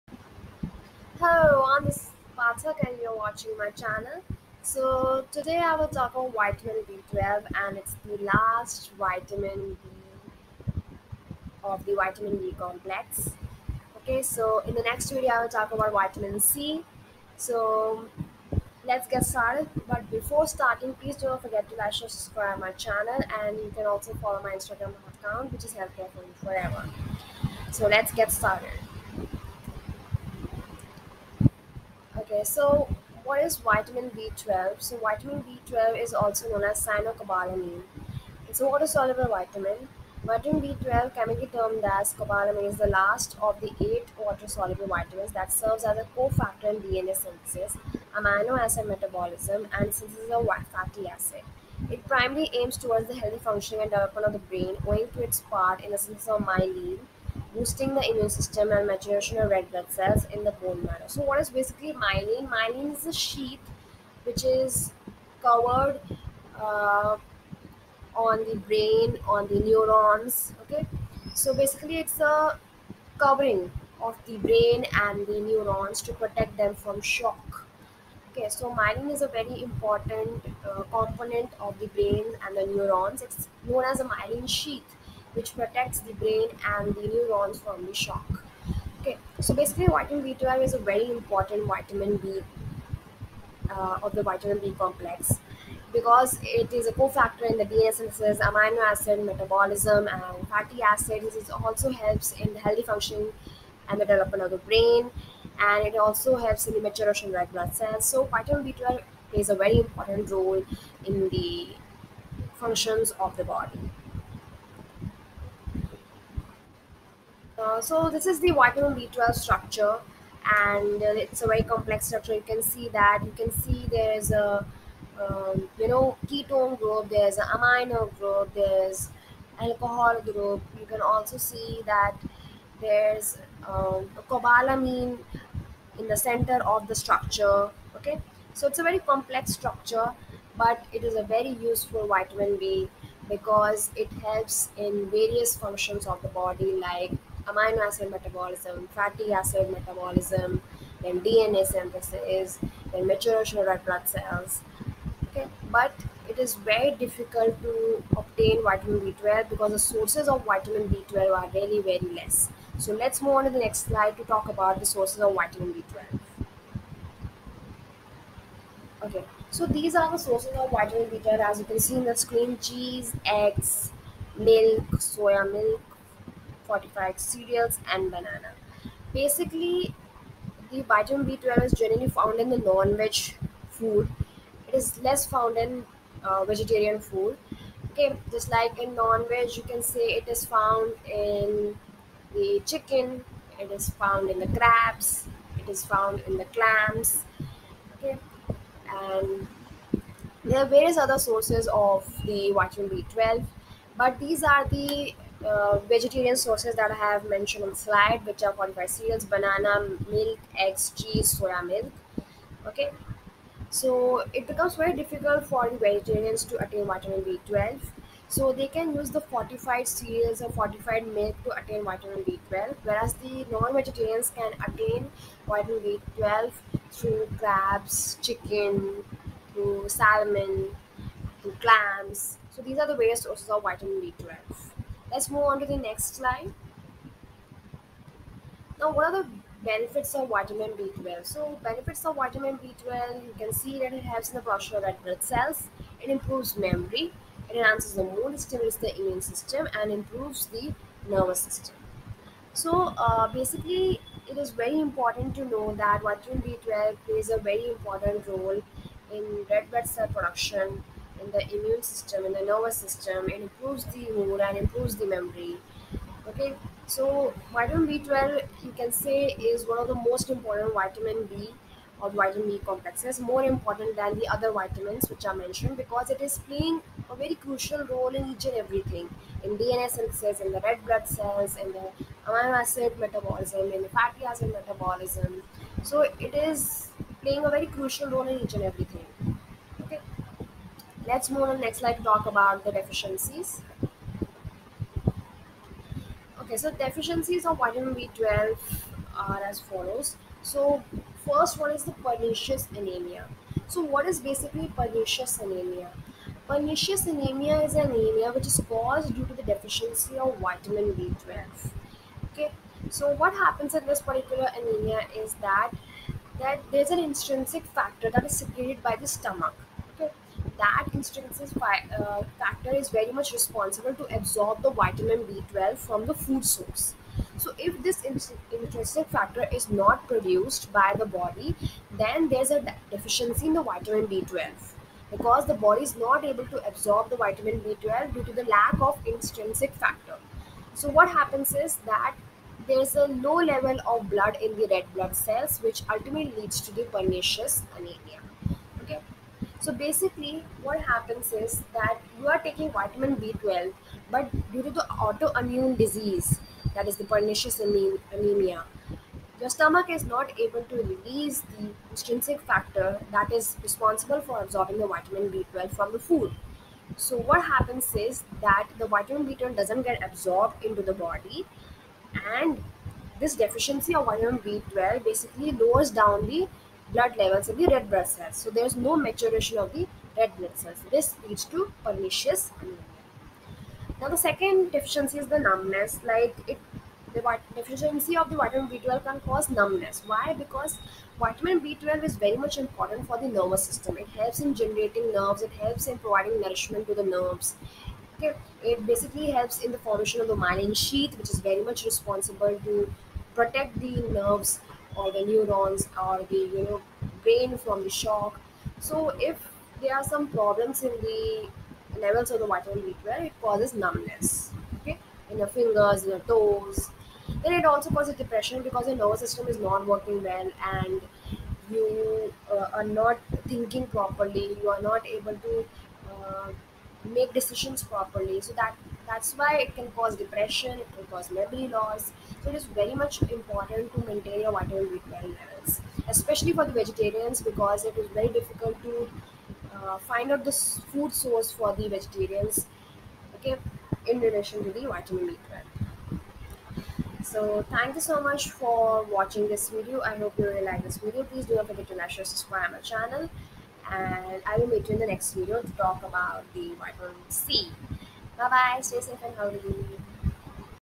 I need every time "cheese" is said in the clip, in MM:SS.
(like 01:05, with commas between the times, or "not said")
02:52, 03:30.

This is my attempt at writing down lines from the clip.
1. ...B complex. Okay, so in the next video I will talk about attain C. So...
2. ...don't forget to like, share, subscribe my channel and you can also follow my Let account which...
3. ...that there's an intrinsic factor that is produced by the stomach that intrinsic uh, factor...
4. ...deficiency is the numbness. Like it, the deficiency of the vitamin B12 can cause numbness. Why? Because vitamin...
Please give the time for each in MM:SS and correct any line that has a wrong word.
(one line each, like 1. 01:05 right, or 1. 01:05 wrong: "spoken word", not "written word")
1. 00:12 wrong: "vitamin", not "attain"
2. 00:21 wrong: "Instagram", not "Let"
3. 05:16 wrong: "secreted", not "produced"
4. 06:24 right.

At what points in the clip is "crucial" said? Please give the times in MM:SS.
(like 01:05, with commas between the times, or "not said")
04:37, 04:47.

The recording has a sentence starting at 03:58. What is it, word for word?
Now, what are the benefits of vitamin B12?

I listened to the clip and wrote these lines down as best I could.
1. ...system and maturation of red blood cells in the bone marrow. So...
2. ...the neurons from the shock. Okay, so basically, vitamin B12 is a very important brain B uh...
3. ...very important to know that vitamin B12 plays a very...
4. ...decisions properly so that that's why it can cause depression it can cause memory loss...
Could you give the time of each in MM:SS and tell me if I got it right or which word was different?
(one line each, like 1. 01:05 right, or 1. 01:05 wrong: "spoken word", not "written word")
1. 00:58 right
2. 01:26 wrong: "vitamin", not "brain"
3. 04:14 right
4. 07:07 right.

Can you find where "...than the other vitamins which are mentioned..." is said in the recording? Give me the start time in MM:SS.
04:33.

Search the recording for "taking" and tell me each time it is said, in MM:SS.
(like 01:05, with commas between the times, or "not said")
05:52.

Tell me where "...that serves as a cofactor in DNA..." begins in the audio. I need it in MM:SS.
00:45.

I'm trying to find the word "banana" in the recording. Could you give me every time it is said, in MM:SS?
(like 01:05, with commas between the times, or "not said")
02:58, 03:29.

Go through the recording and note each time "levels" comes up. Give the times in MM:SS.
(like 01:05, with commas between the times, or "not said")
05:43, 06:17, 06:51, 07:15.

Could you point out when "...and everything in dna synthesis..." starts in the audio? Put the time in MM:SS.
04:38.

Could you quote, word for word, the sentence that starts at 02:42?
So let's move on to the next slide to talk about the sources of vitamin B12.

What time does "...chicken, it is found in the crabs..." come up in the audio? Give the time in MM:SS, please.
03:12.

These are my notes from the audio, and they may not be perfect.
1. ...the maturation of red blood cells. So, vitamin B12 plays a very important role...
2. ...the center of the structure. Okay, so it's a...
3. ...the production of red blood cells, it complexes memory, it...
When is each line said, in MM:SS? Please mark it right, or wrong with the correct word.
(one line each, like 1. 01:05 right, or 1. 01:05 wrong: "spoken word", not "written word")
1. 01:46 right
2. 02:16 right
3. 04:04 wrong: "improves", not "complexes".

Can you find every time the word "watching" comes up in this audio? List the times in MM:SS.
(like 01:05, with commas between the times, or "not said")
00:03, 07:29.